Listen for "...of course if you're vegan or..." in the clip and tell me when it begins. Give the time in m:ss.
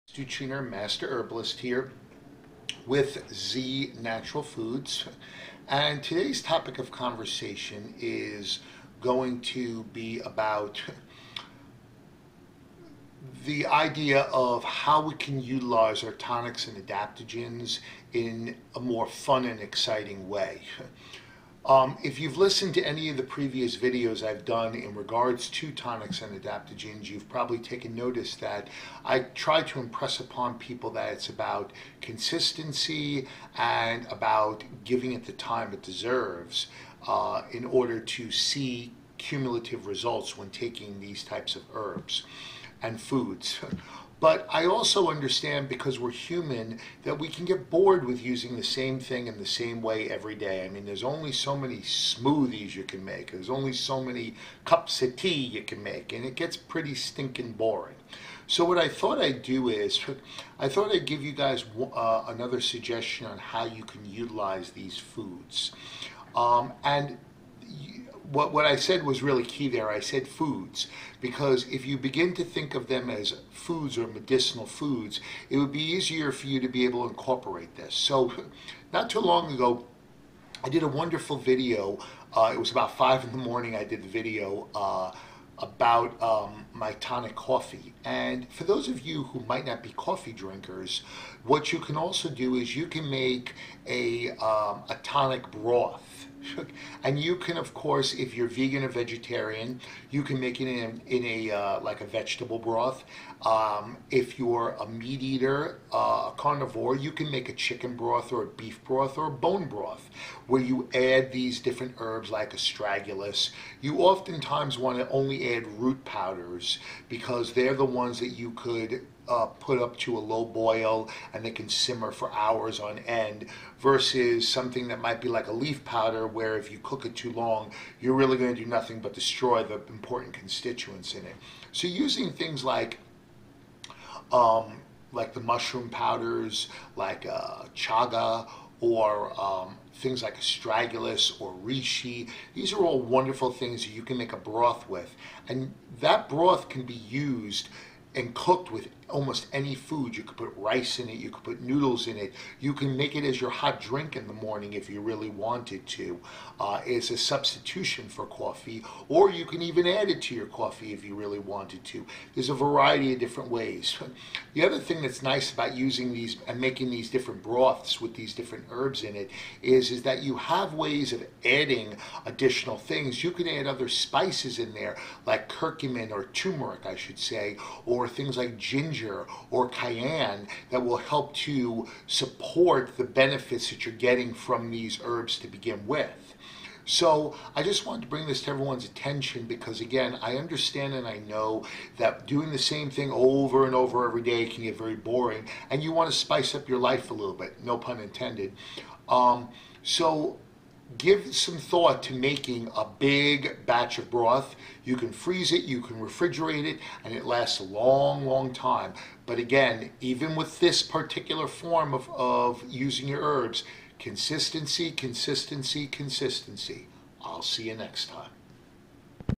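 1:37.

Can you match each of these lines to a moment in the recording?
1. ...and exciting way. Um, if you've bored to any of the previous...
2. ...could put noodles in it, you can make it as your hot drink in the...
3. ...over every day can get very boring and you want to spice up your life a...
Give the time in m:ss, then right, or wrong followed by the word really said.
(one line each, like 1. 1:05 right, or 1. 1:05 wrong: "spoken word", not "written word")
1. 0:19 wrong: "listened", not "bored"
2. 2:31 right
3. 3:13 right.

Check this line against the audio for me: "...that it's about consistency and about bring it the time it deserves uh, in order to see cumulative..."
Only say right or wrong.
wrong.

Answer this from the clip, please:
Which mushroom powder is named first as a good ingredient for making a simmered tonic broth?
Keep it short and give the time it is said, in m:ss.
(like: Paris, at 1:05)
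chaga, at 2:17.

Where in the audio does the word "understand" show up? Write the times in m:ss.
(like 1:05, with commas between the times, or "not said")
0:45, 3:10.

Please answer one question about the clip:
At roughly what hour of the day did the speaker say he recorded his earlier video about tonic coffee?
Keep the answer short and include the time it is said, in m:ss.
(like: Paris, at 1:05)
5 in the morning, at 1:22.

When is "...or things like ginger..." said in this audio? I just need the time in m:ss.
2:58.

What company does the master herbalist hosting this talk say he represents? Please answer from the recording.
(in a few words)
Z Natural Foods.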